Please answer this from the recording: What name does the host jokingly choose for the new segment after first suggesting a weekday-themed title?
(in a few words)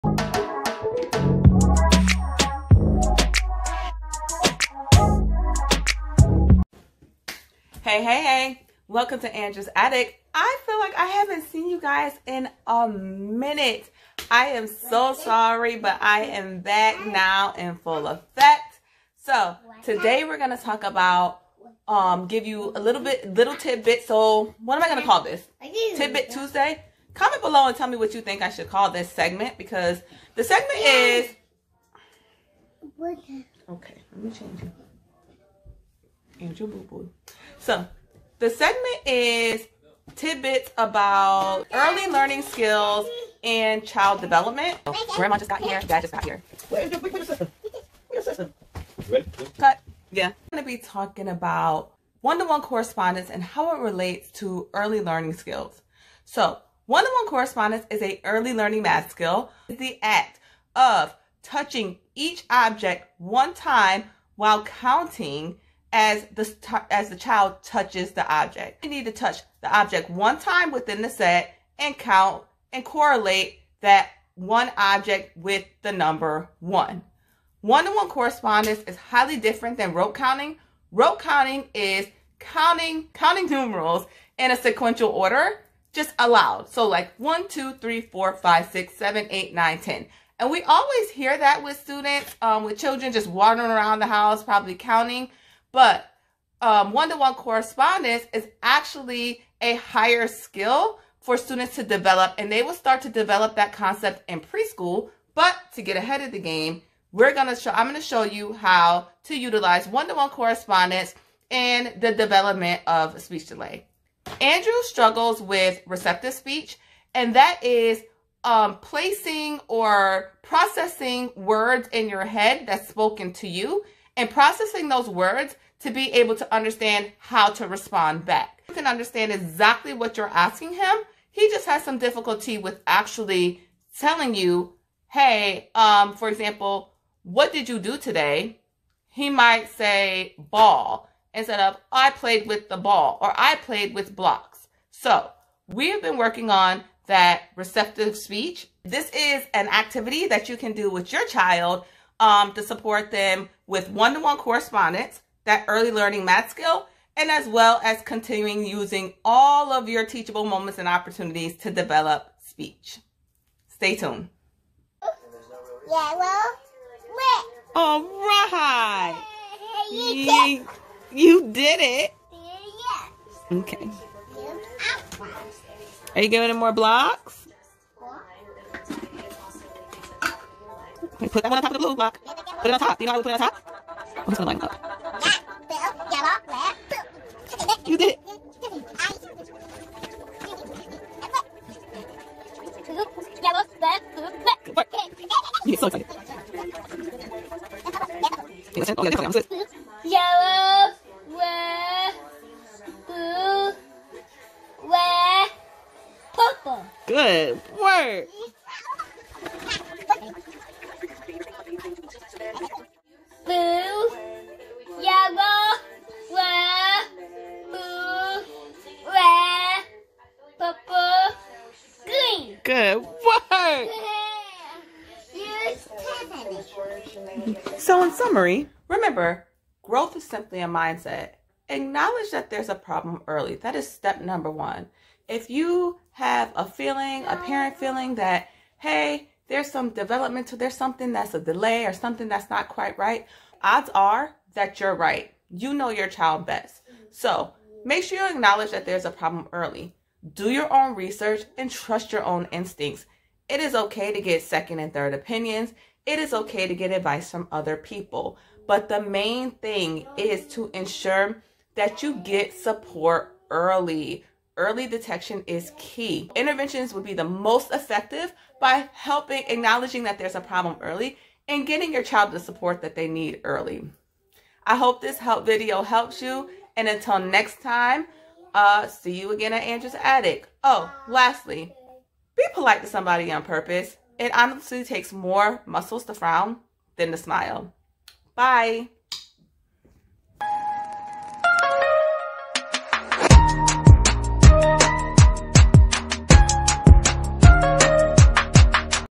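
Angel Boo Boo.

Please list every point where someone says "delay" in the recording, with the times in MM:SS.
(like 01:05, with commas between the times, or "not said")
01:53, 04:01.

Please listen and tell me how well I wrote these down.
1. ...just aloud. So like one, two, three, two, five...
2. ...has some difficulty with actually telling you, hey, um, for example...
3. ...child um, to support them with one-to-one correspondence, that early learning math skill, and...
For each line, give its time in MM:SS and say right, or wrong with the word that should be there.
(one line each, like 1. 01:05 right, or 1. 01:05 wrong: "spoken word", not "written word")
1. 01:25 wrong: "four", not "two"
2. 02:11 right
3. 02:31 right.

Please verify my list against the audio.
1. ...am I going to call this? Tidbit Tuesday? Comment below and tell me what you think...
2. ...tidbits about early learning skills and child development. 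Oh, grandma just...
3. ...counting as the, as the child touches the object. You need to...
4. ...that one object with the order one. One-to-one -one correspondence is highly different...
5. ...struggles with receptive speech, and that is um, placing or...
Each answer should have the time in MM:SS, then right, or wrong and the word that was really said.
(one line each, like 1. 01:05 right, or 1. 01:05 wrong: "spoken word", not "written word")
1. 00:24 right
2. 00:40 right
3. 01:04 right
4. 01:13 wrong: "number", not "order"
5. 01:54 right.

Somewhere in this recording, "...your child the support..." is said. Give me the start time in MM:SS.
04:31.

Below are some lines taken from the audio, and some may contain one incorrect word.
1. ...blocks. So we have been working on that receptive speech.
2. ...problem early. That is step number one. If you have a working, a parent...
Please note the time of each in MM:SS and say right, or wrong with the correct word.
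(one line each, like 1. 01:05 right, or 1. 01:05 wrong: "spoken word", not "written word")
1. 02:24 right
2. 03:52 wrong: "feeling", not "working".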